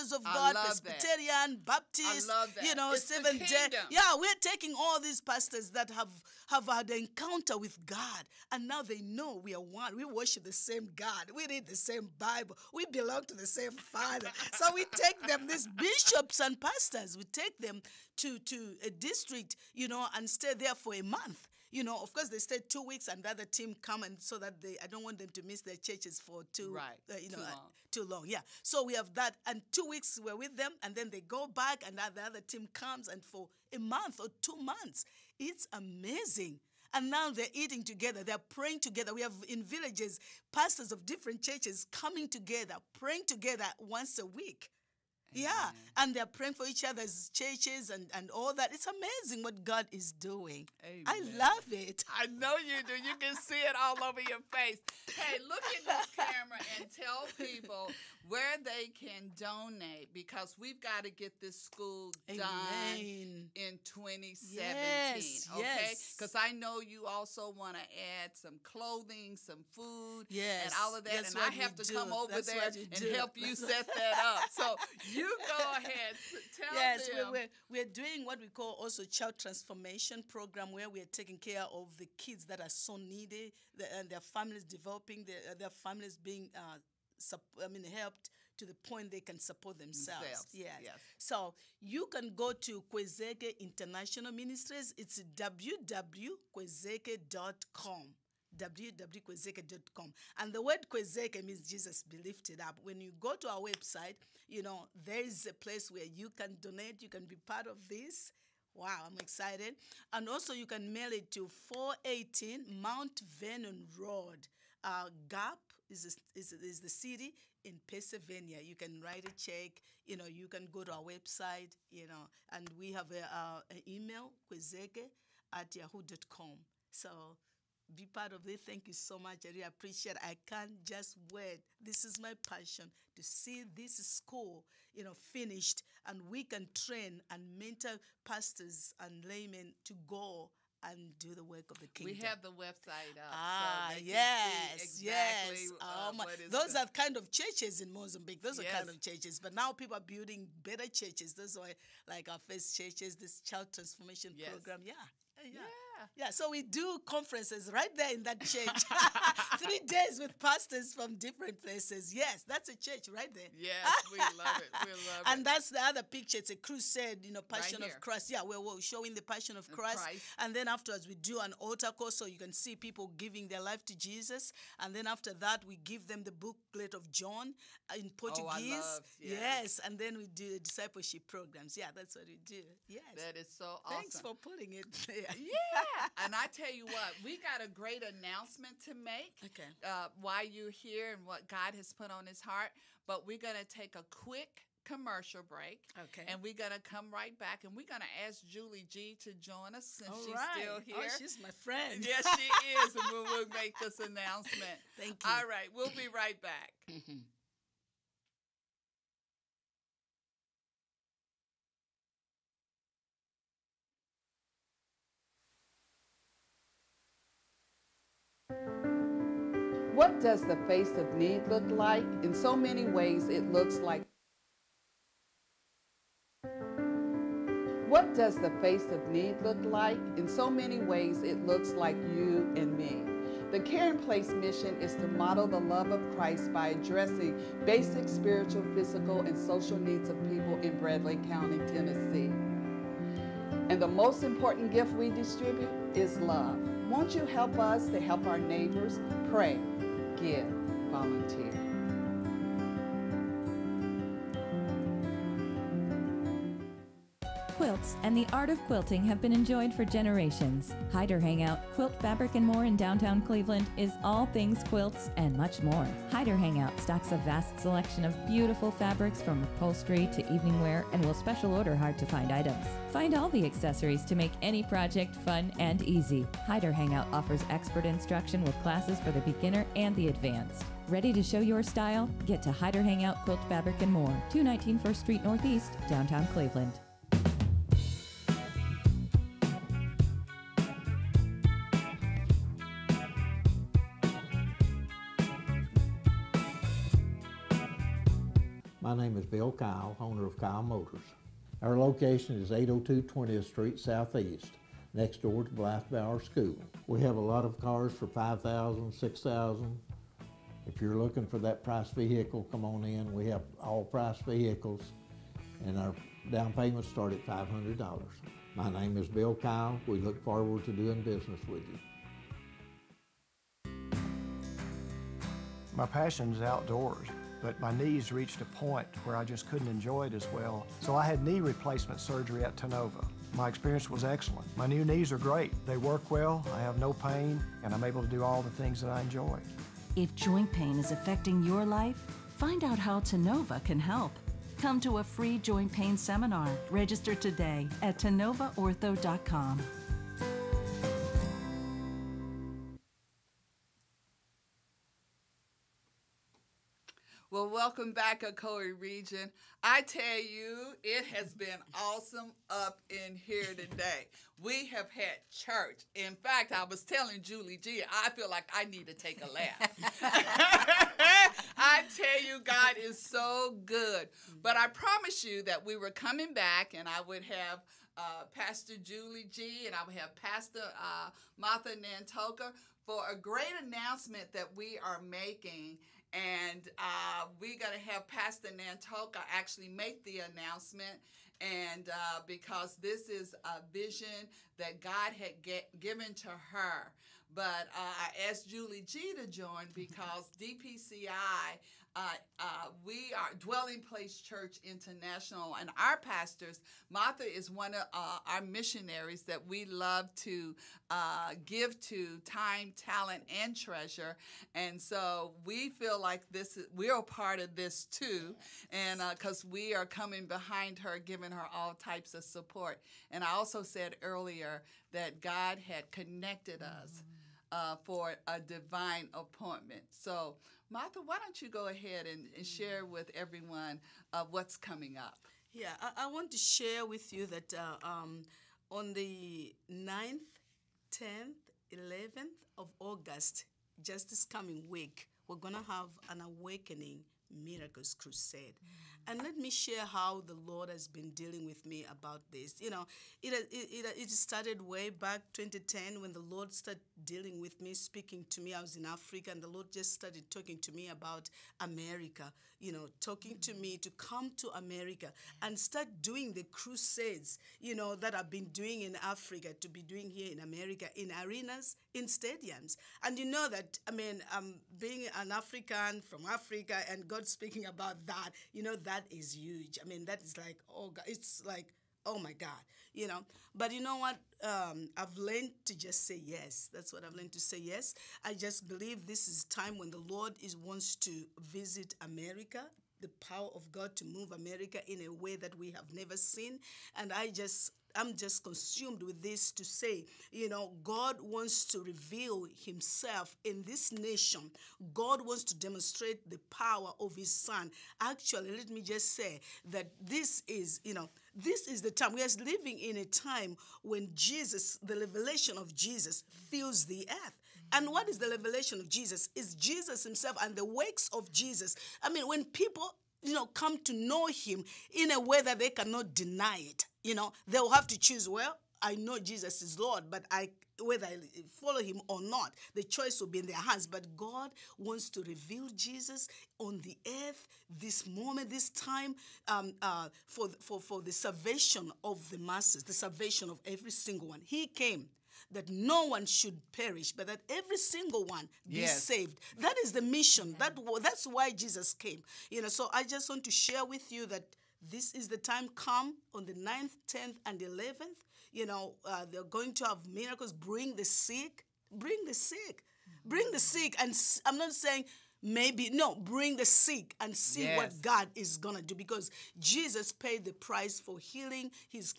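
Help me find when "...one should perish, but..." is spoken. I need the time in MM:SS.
09:06.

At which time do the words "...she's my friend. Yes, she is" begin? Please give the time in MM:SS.
03:21.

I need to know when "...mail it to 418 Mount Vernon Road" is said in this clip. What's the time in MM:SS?
01:50.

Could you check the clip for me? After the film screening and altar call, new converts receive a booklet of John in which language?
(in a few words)
Portuguese.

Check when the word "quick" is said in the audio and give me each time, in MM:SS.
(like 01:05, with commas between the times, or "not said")
03:14.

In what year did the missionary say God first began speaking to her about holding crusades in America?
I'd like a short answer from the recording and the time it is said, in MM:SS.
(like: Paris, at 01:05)
2010, at 07:35.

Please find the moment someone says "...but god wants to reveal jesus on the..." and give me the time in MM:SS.
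08:53.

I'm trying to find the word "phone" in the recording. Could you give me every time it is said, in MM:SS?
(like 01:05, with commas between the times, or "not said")
not said.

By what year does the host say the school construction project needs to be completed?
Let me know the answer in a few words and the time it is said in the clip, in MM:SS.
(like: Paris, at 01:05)
2017, at 01:03.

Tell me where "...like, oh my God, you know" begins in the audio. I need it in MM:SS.
08:01.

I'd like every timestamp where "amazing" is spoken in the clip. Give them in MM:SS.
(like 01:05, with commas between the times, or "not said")
00:35, 00:48.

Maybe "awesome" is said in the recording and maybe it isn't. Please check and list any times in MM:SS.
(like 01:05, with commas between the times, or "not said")
03:03, 06:01.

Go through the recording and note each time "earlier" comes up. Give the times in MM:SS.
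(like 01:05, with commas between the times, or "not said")
07:04.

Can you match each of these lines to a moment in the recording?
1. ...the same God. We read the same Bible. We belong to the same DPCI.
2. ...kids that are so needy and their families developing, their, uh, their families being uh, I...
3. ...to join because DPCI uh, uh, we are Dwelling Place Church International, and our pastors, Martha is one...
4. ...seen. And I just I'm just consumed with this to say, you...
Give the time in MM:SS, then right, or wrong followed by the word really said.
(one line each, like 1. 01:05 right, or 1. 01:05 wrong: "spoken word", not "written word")
1. 00:10 wrong: "Father", not "DPCI"
2. 01:22 right
3. 06:39 right
4. 08:16 right.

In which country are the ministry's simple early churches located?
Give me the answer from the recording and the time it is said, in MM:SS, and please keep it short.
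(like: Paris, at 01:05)
Mozambique, at 02:27.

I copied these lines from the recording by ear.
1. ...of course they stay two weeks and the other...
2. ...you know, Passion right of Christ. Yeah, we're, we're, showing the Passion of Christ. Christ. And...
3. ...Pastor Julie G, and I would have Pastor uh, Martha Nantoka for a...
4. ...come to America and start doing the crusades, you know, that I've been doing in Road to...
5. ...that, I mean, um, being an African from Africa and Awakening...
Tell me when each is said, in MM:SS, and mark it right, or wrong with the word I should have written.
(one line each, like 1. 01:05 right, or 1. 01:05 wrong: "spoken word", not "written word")
1. 00:22 right
2. 02:47 right
3. 06:18 right
4. 07:43 wrong: "Africa", not "Road"
5. 07:53 wrong: "God", not "Awakening".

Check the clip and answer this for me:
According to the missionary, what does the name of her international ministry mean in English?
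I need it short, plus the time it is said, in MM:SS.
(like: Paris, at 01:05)
Jesus be lifted up, at 01:41.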